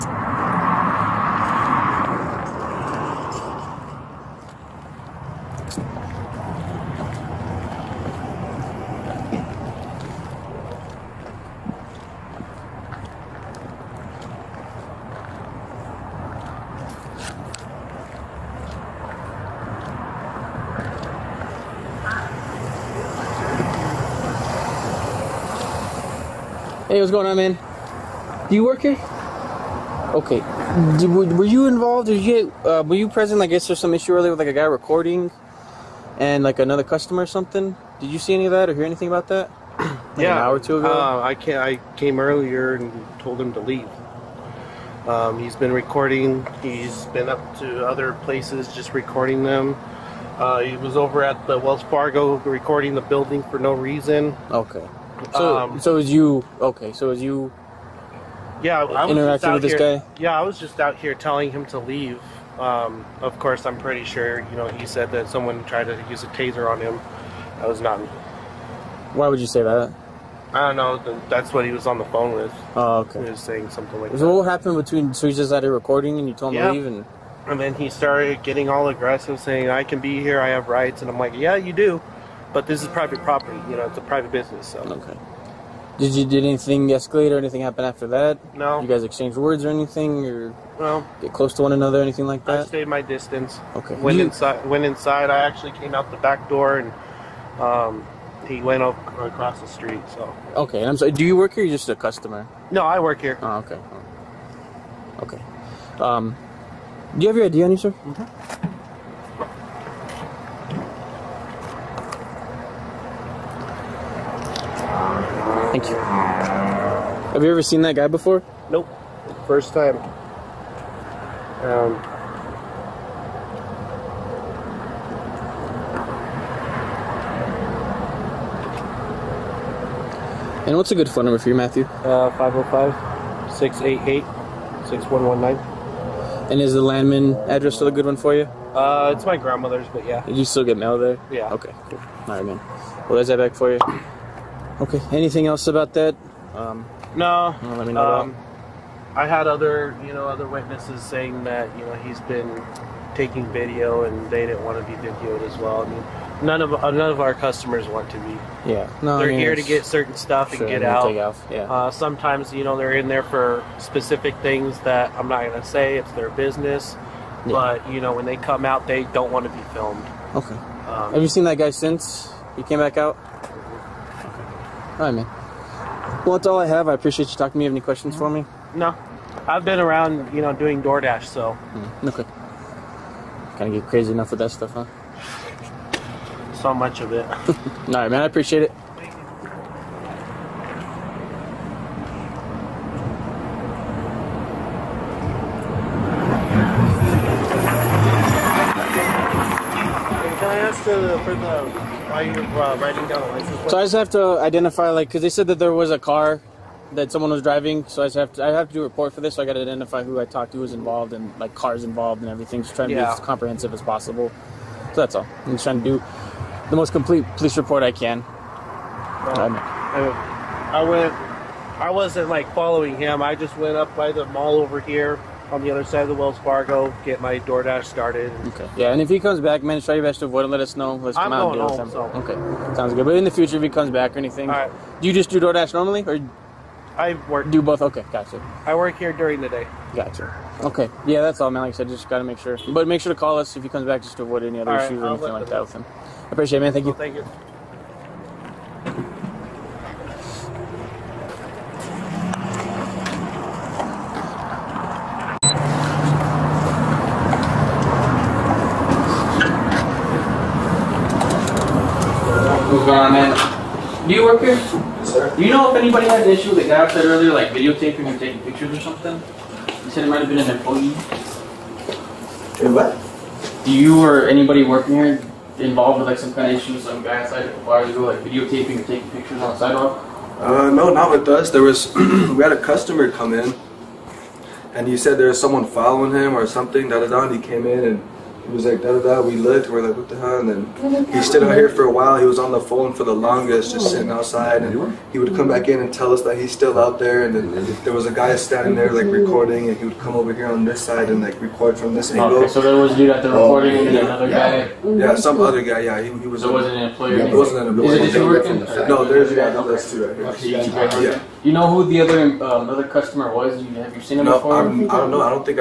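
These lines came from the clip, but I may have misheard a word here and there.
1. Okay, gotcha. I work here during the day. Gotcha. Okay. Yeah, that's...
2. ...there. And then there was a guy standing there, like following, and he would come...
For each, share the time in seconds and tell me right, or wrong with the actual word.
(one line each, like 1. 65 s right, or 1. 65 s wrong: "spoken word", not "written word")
1. 237 s right
2. 296 s wrong: "recording", not "following".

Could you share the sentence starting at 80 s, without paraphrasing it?
I have rights." And I'm like, "Yeah, you do." But this is private property, you know, it's a private business.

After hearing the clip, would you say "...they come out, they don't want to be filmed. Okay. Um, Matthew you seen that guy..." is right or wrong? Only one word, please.
wrong.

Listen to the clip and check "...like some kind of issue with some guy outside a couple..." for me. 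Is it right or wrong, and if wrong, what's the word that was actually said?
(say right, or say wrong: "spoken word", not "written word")
right.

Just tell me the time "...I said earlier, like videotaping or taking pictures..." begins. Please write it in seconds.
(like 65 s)
266 s.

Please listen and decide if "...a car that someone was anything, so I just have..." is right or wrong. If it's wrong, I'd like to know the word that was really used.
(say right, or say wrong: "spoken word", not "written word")
wrong: "driving", not "anything".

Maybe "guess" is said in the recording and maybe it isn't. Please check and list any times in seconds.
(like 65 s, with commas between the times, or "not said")
33 s.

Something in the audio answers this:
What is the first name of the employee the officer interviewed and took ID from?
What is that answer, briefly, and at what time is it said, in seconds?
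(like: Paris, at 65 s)
Matthew, at 131 s.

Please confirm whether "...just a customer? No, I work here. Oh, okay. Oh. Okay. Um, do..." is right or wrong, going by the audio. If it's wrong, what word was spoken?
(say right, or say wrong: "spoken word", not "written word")
right.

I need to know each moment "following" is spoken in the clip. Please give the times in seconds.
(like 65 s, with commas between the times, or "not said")
222 s, 285 s.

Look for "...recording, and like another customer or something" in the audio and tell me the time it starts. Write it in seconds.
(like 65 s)
34 s.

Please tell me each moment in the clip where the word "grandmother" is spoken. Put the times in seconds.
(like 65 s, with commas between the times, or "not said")
139 s.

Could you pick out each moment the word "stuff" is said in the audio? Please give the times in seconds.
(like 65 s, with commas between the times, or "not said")
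160 s, 184 s.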